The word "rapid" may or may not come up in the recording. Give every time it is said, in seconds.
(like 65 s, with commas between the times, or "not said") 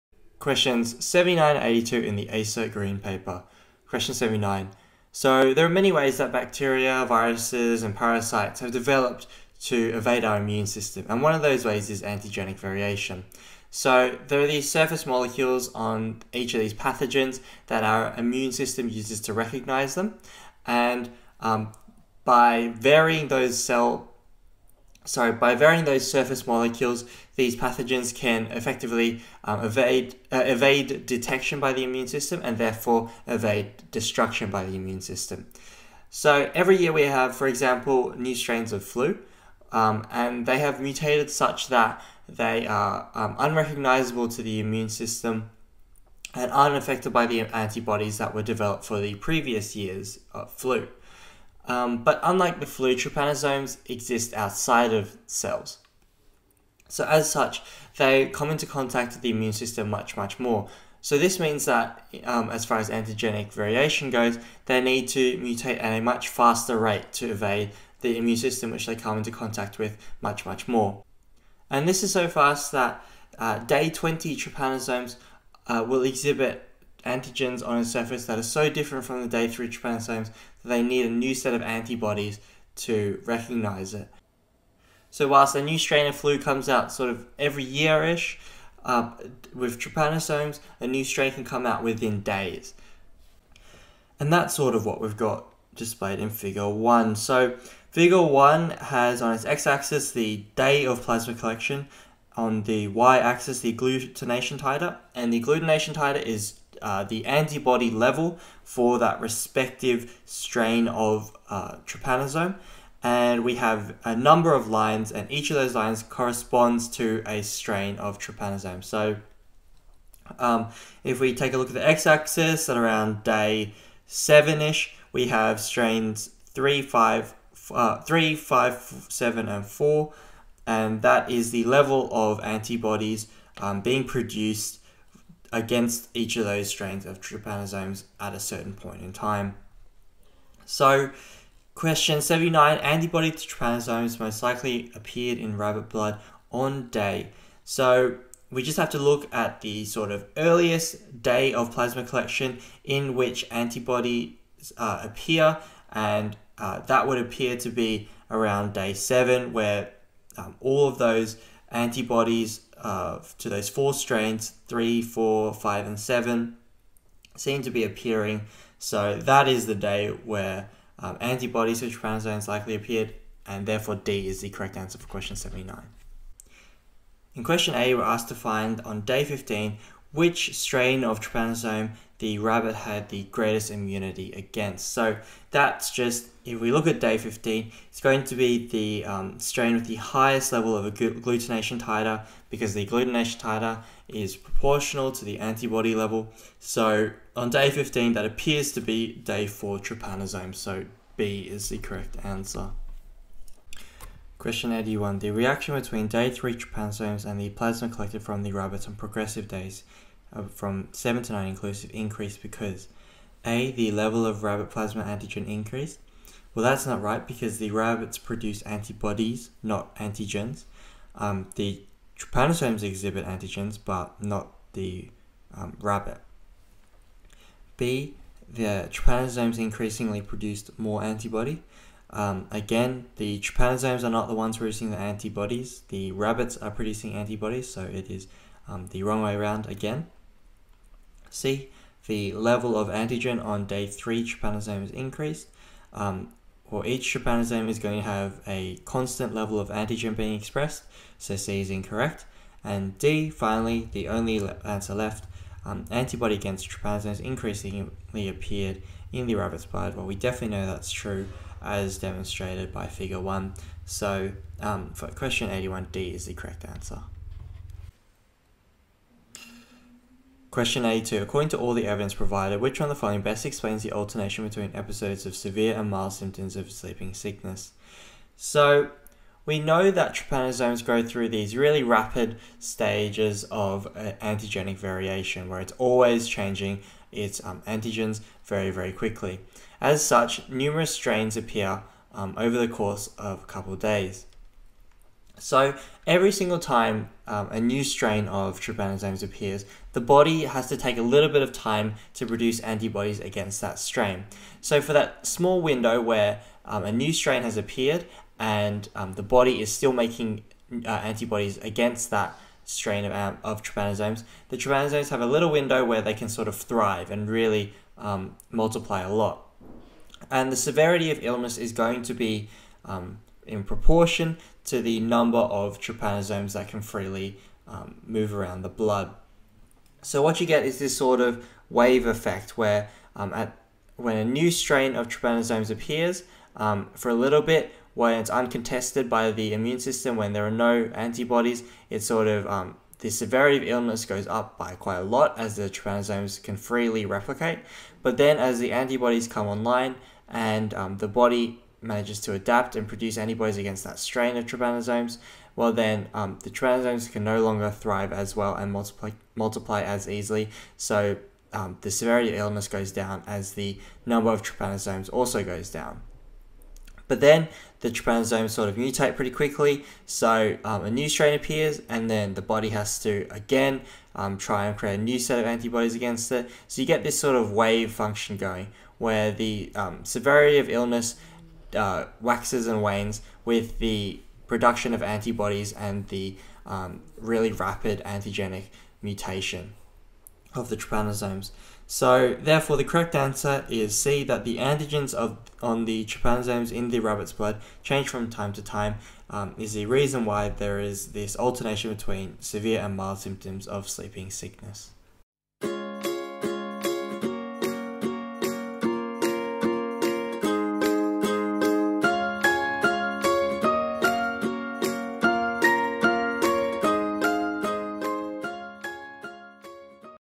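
281 s, 387 s.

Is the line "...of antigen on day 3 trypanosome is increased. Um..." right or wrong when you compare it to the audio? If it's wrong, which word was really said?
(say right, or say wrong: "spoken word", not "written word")
right.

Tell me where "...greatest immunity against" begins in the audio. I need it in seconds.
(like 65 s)
183 s.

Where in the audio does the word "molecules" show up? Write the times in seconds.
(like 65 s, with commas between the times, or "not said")
15 s, 26 s.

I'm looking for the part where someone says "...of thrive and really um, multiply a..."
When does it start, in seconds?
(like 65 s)
316 s.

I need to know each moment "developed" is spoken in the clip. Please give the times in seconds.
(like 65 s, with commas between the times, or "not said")
8 s, 48 s.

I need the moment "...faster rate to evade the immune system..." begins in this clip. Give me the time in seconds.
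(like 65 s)
66 s.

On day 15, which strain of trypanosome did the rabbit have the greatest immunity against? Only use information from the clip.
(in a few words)
Day 4 trypanosome.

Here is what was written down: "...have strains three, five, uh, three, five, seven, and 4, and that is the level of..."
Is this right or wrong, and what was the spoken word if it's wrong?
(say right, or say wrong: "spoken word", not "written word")
right.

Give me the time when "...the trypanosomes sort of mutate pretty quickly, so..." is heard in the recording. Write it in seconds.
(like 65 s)
367 s.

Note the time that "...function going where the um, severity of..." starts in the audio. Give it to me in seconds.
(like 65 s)
377 s.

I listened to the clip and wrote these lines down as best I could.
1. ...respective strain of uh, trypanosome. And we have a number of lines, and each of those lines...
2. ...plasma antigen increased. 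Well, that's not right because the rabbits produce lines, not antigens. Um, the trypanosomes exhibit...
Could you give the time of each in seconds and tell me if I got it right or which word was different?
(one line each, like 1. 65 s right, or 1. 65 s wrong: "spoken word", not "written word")
1. 109 s right
2. 214 s wrong: "antibodies", not "lines".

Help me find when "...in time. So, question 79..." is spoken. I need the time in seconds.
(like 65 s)
139 s.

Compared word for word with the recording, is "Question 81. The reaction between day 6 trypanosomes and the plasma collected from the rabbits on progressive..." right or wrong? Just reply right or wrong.
wrong.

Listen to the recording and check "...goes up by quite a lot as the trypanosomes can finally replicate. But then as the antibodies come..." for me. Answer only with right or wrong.
wrong.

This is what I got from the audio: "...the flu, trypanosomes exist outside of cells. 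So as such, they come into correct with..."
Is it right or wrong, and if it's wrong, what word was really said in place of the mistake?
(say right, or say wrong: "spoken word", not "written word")
wrong: "contact", not "correct".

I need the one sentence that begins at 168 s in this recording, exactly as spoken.
So that is the day where um, antibodies to trypanosomes likely appeared, and therefore D is the correct answer for question 79.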